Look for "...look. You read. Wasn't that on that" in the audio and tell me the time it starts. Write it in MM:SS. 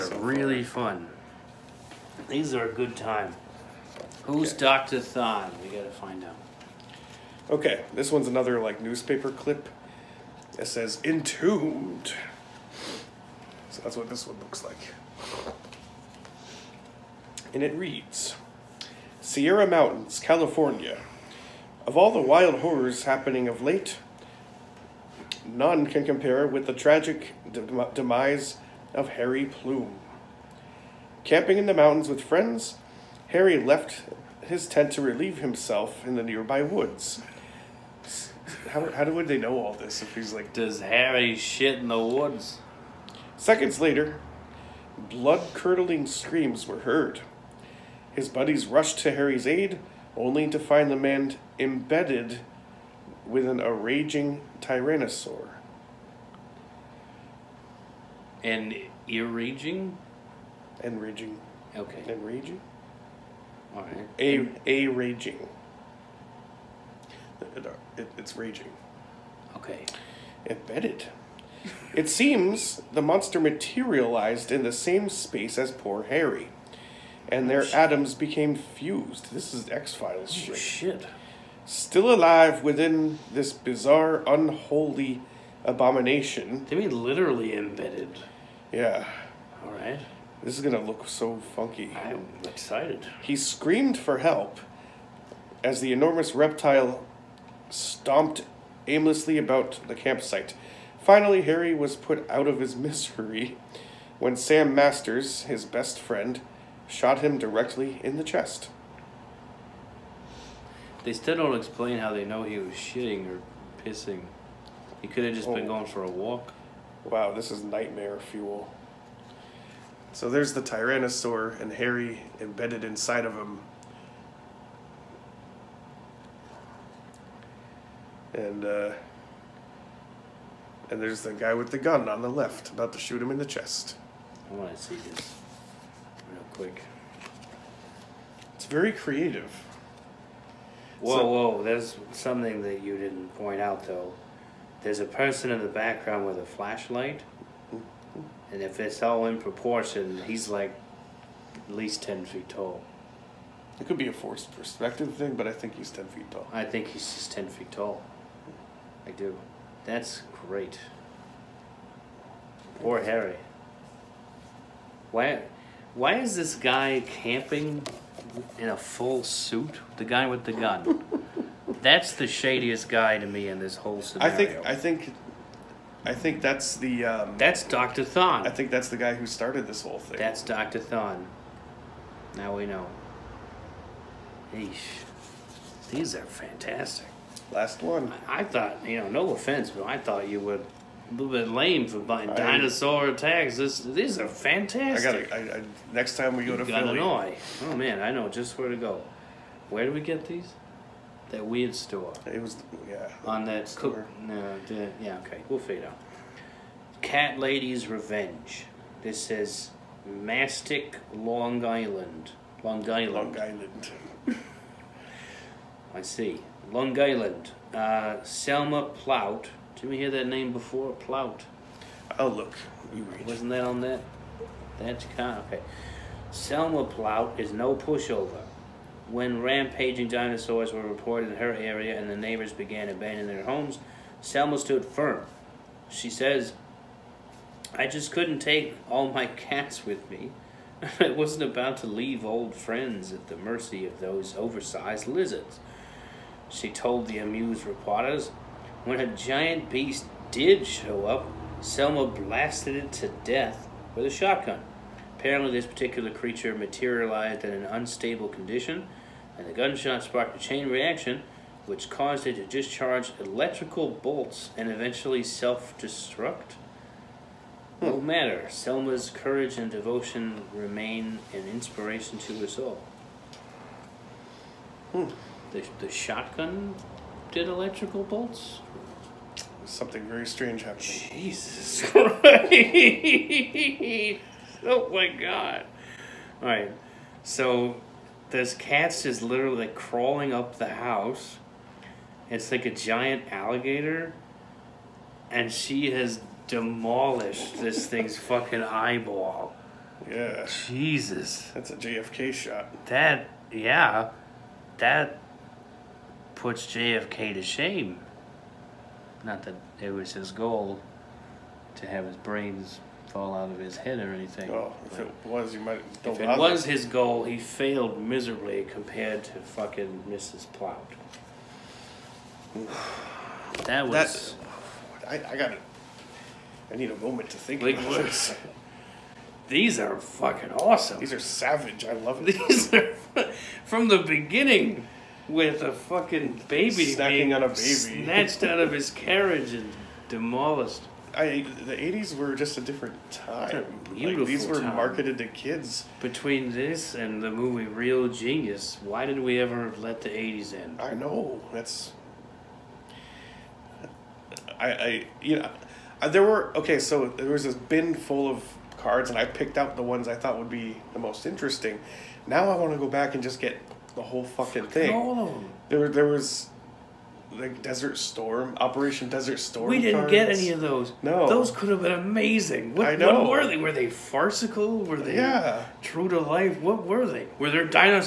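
03:42.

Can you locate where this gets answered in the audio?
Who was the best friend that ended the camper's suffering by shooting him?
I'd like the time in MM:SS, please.
01:44.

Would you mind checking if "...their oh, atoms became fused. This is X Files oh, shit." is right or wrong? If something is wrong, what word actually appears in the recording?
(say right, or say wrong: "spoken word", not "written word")
right.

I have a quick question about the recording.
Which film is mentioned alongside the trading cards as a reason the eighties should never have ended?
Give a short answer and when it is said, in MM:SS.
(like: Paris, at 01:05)
Real Genius, at 05:47.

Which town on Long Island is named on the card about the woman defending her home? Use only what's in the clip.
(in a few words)
Mastic.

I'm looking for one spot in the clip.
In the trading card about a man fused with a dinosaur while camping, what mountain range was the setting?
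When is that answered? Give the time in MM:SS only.
00:19.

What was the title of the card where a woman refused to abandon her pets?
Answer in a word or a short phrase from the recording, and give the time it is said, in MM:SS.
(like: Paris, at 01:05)
Cat Lady's Revenge, at 03:27.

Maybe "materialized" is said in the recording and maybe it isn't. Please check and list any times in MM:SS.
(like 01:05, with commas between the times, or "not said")
01:13, 04:16.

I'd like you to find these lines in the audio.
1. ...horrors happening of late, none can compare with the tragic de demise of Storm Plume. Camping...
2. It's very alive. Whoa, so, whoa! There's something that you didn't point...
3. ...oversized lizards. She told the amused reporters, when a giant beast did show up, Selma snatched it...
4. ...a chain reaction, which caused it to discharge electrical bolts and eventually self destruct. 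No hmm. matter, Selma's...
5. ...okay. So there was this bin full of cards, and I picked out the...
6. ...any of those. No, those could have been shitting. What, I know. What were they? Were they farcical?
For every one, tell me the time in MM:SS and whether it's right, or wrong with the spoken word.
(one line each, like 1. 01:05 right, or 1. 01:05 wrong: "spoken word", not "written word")
1. 00:22 wrong: "Harry", not "Storm"
2. 02:18 wrong: "creative", not "alive"
3. 04:04 wrong: "blasted", not "snatched"
4. 04:20 right
5. 05:56 right
6. 06:10 wrong: "amazing", not "shitting".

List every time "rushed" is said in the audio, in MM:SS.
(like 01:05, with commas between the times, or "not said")
00:48.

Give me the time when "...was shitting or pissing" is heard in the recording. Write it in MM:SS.
01:52.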